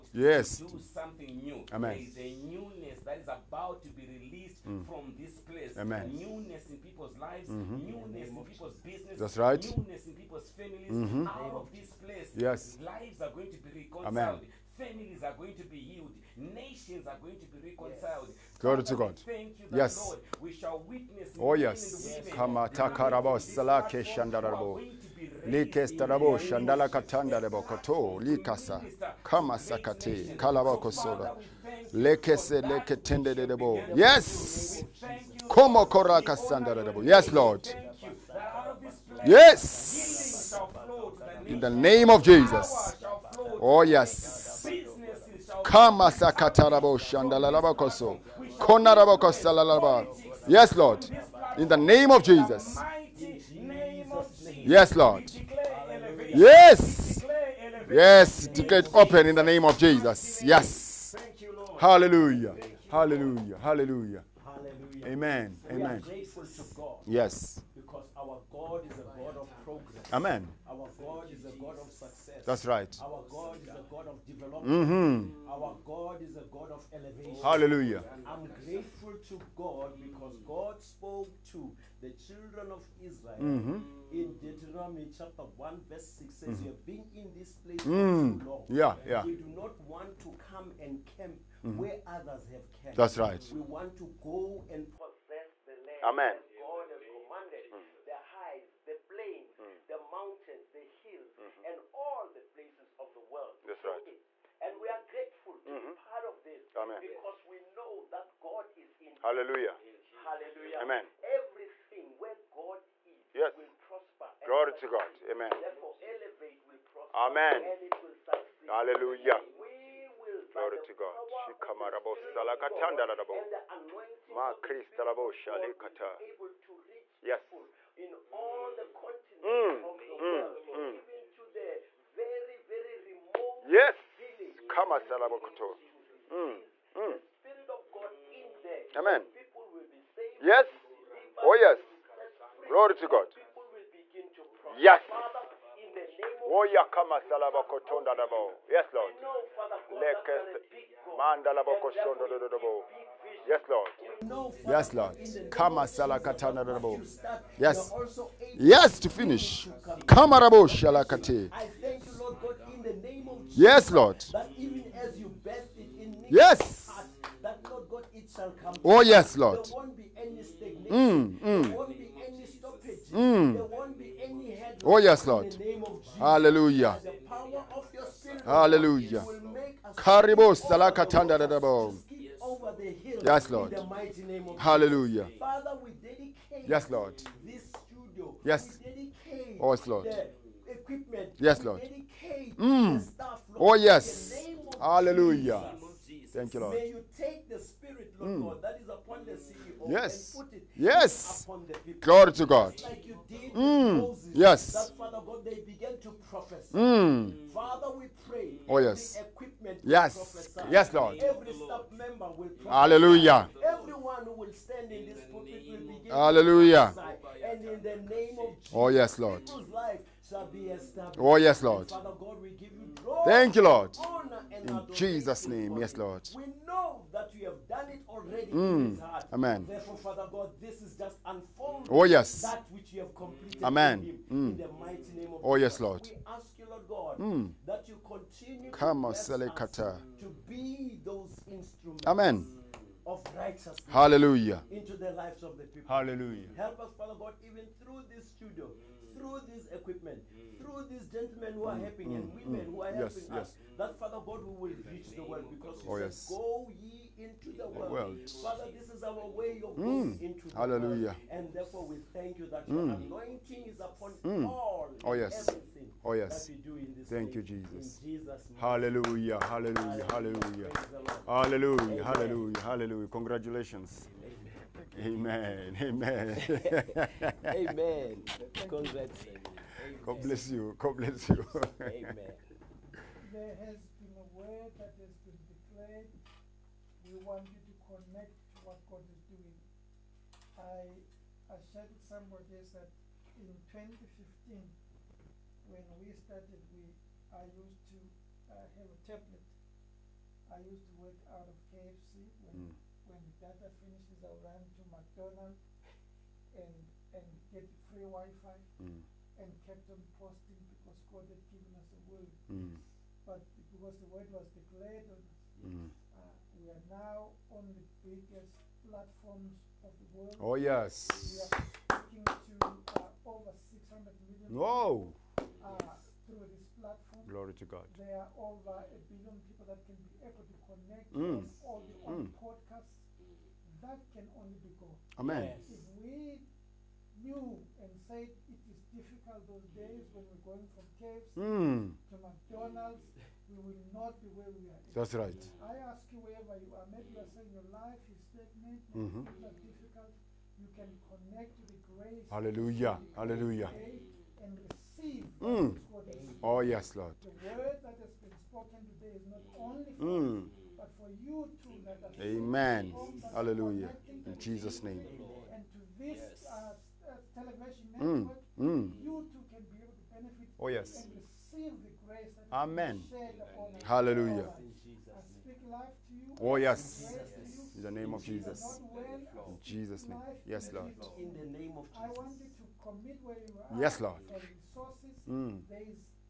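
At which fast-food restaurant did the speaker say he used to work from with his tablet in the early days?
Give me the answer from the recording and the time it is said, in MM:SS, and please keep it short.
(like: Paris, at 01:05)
KFC, at 05:01.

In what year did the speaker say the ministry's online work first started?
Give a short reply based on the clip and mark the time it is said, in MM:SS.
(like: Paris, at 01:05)
2015, at 04:53.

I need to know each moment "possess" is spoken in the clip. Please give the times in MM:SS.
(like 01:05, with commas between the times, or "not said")
01:34.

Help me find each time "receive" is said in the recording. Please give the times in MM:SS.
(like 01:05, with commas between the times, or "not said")
05:54, 06:11.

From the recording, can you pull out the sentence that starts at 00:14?
Amen Families are going to be healed.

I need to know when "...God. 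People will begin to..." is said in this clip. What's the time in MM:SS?
02:23.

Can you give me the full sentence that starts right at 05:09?
and kept on posting because God had given us a word.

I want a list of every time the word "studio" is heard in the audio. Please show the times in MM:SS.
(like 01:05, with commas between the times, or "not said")
03:07, 04:08.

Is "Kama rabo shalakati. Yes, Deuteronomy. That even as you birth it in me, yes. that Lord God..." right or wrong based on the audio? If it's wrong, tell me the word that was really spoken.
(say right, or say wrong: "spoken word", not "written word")
wrong: "Lord", not "Deuteronomy".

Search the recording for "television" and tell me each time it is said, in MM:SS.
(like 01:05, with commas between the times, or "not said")
06:07.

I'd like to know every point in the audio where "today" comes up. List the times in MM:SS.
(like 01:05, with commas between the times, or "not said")
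05:58.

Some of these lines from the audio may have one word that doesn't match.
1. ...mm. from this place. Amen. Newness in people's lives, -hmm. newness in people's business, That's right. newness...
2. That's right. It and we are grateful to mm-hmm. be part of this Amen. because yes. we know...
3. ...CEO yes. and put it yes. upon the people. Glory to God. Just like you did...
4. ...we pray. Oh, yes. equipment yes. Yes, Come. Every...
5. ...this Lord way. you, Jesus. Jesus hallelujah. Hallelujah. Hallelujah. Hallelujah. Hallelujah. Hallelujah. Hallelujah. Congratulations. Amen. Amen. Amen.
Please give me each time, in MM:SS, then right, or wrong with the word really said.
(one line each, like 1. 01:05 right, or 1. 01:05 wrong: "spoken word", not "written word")
1. 00:04 right
2. 01:43 right
3. 03:19 right
4. 03:27 wrong: "Lord", not "Come"
5. 04:26 wrong: "Thank", not "Lord".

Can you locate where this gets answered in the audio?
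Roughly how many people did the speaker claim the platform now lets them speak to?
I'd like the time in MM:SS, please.
05:23.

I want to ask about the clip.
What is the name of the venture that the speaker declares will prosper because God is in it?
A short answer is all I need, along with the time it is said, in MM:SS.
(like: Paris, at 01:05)
Elev8, at 01:56.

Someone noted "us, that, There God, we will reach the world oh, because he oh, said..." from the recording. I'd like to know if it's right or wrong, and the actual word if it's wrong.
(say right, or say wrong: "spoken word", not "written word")
wrong: "Father", not "There".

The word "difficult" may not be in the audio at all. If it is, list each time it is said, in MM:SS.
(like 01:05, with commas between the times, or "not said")
05:38, 05:49.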